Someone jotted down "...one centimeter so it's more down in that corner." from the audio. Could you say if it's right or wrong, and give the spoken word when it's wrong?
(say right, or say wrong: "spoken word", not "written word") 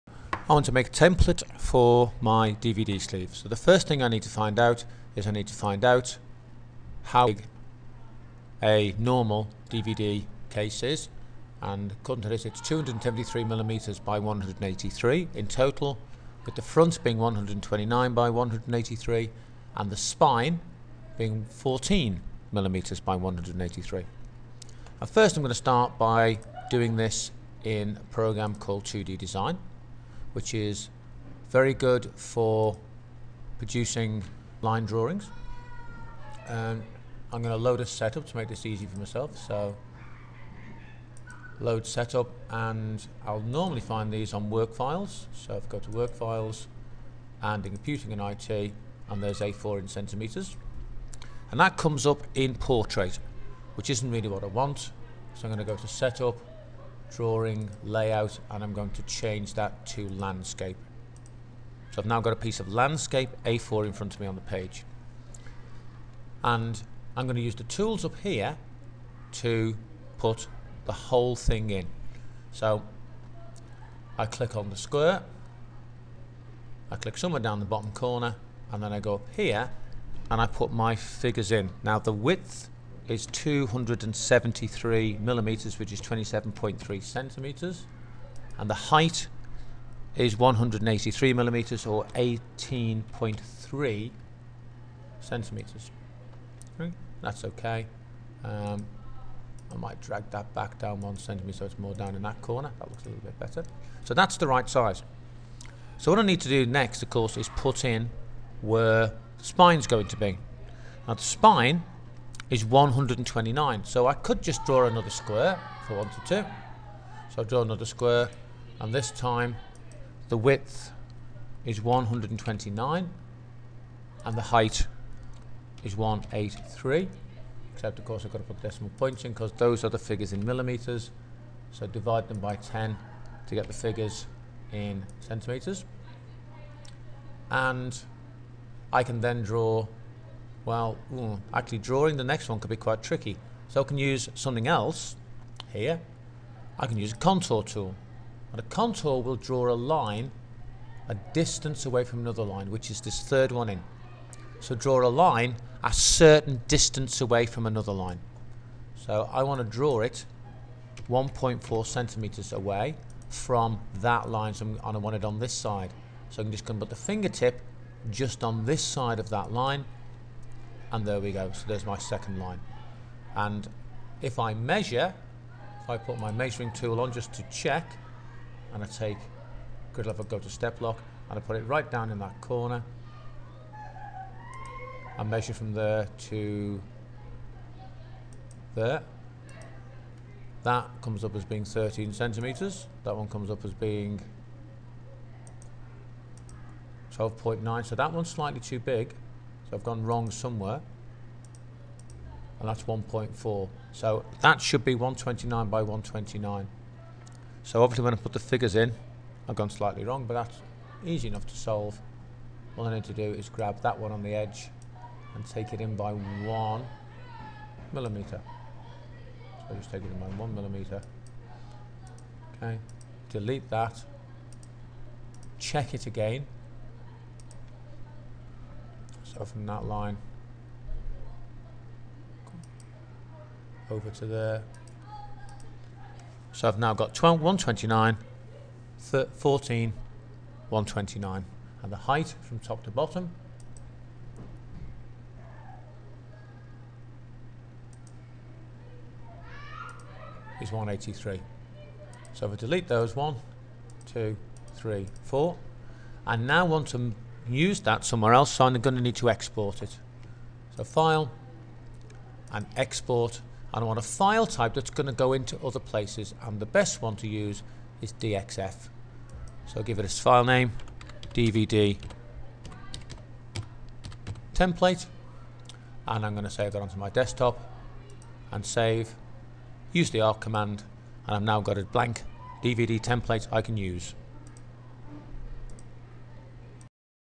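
right.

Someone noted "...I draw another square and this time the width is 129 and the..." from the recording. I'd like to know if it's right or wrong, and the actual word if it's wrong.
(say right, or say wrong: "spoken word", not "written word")
right.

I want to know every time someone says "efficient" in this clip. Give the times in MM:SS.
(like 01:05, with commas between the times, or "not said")
not said.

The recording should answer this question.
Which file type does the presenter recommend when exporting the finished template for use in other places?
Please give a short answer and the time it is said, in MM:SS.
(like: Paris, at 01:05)
DXF, at 04:28.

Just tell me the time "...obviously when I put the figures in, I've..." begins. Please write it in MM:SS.
03:27.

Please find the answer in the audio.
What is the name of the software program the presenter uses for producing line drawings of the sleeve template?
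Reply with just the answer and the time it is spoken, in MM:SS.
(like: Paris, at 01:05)
2D Design, at 00:28.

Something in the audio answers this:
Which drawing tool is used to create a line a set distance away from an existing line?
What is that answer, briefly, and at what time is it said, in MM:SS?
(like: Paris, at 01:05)
contour tool, at 02:27.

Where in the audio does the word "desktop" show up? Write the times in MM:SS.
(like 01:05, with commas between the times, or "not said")
04:37.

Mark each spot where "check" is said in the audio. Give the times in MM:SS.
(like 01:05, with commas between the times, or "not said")
02:57, 03:45.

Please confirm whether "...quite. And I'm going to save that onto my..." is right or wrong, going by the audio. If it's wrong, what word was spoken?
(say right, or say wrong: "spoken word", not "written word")
wrong: "template", not "quite".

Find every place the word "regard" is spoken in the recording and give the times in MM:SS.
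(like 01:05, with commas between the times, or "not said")
not said.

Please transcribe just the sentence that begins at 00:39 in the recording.
So load setup and I'll normally find these on work files.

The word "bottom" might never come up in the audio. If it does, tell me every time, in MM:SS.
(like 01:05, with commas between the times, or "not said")
01:17, 04:02.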